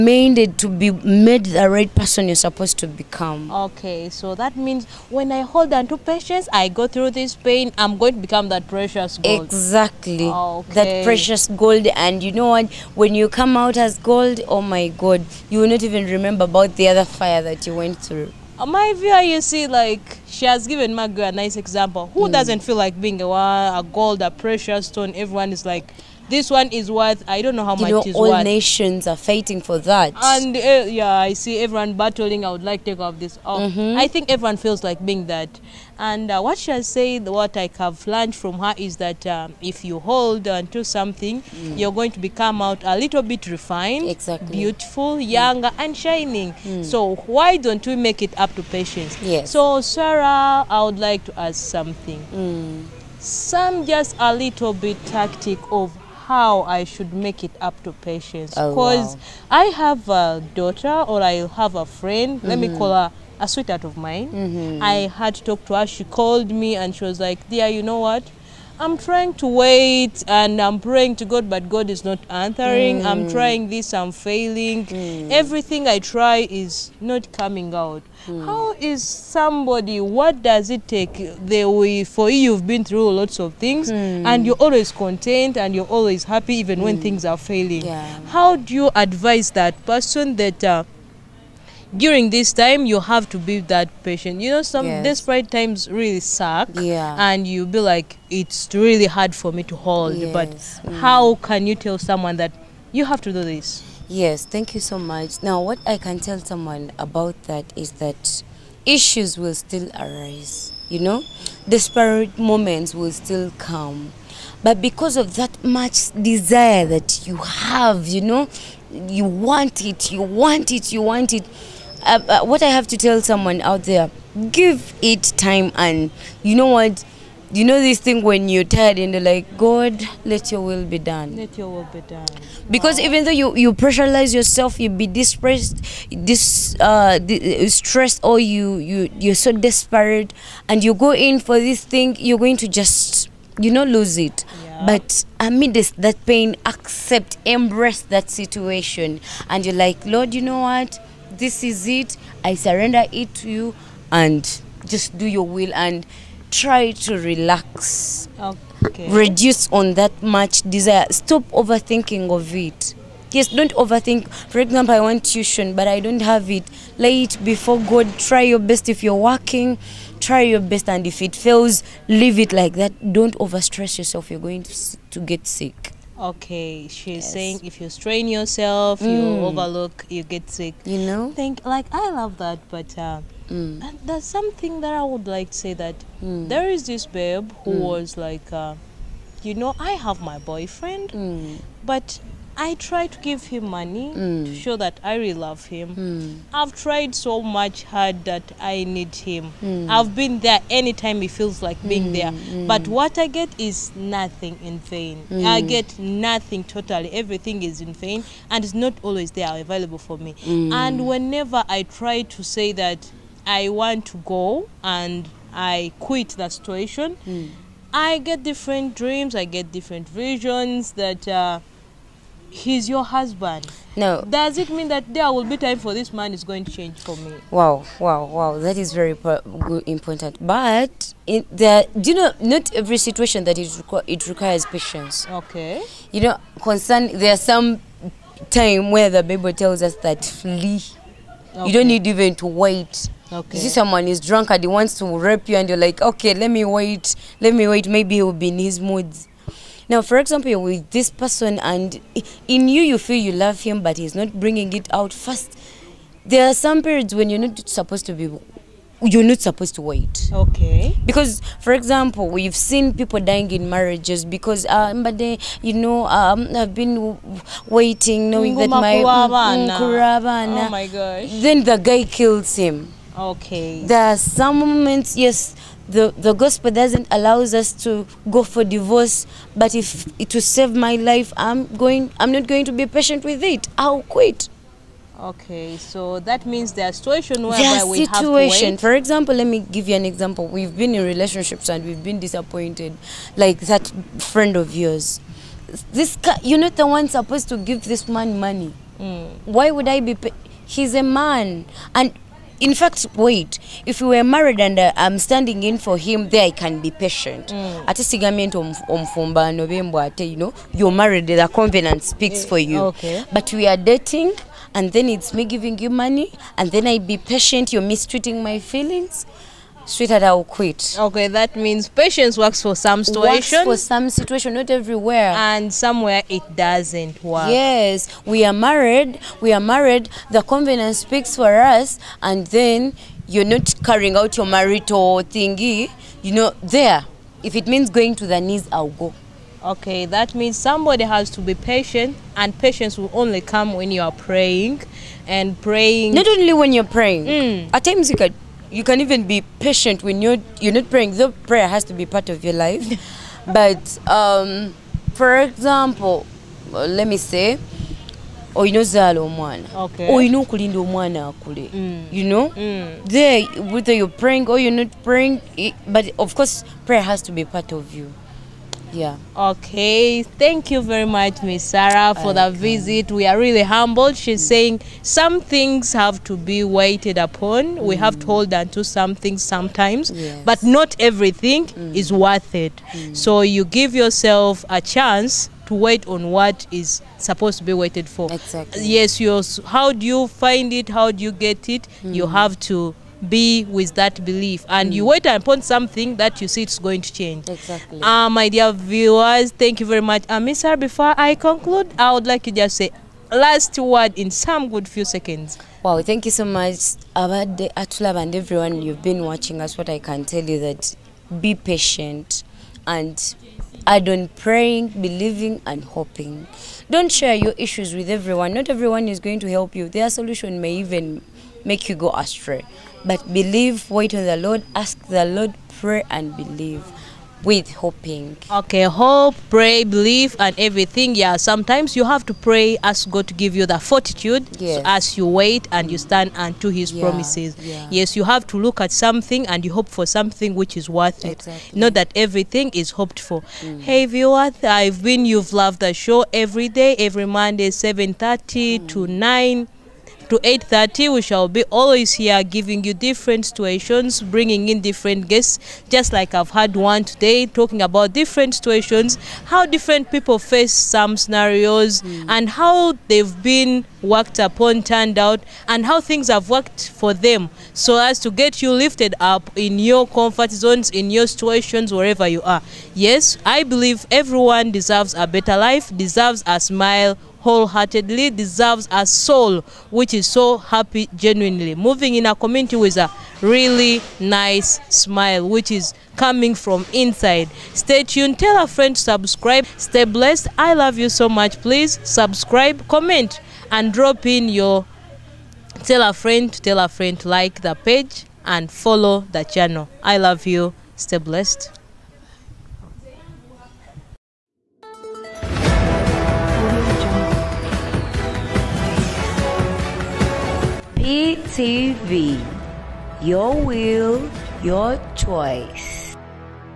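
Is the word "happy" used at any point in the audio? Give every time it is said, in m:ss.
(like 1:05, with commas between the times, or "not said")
1:26, 8:00.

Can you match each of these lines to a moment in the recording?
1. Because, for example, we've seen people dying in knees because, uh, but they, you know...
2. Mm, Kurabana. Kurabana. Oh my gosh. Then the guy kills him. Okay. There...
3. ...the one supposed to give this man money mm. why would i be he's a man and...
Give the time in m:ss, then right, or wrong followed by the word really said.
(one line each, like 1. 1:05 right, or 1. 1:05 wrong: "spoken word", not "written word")
1. 4:21 wrong: "marriages", not "knees"
2. 4:28 right
3. 4:56 right.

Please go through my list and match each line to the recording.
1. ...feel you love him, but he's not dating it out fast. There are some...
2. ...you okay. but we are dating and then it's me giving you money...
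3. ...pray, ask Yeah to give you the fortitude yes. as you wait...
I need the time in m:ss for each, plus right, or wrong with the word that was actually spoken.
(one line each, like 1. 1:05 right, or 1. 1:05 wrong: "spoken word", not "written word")
1. 4:12 wrong: "bringing", not "dating"
2. 5:12 right
3. 7:12 wrong: "God", not "Yeah".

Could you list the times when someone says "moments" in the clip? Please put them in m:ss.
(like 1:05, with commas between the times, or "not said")
1:52, 4:34.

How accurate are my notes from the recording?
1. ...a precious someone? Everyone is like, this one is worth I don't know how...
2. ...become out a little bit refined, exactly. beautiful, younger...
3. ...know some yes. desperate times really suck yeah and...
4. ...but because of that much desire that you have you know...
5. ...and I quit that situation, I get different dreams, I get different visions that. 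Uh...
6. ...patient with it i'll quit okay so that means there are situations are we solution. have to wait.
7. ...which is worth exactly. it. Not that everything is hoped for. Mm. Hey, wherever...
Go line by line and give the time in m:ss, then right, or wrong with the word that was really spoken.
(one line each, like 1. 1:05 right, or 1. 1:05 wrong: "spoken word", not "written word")
1. 0:24 wrong: "stone", not "someone"
2. 0:42 right
3. 1:34 right
4. 1:54 right
5. 3:34 right
6. 4:42 wrong: "situation", not "solution"
7. 7:20 wrong: "viewer", not "wherever".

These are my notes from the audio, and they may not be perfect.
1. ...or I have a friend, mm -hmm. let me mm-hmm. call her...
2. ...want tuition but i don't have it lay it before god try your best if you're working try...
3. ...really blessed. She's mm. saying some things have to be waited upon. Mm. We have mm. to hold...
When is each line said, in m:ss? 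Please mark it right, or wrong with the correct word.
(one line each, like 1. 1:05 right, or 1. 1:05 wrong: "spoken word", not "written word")
1. 1:01 right
2. 2:44 right
3. 6:13 wrong: "humbled", not "blessed".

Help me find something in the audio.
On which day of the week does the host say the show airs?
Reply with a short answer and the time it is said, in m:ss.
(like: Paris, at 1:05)
Monday, at 7:27.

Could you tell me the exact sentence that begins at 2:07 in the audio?
You know this thing when you're tired and they are like, God, let your will be done.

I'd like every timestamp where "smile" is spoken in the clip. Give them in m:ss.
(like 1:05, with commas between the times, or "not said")
7:56, 8:04.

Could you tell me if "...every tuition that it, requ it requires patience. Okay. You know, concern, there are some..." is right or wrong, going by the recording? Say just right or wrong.
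wrong.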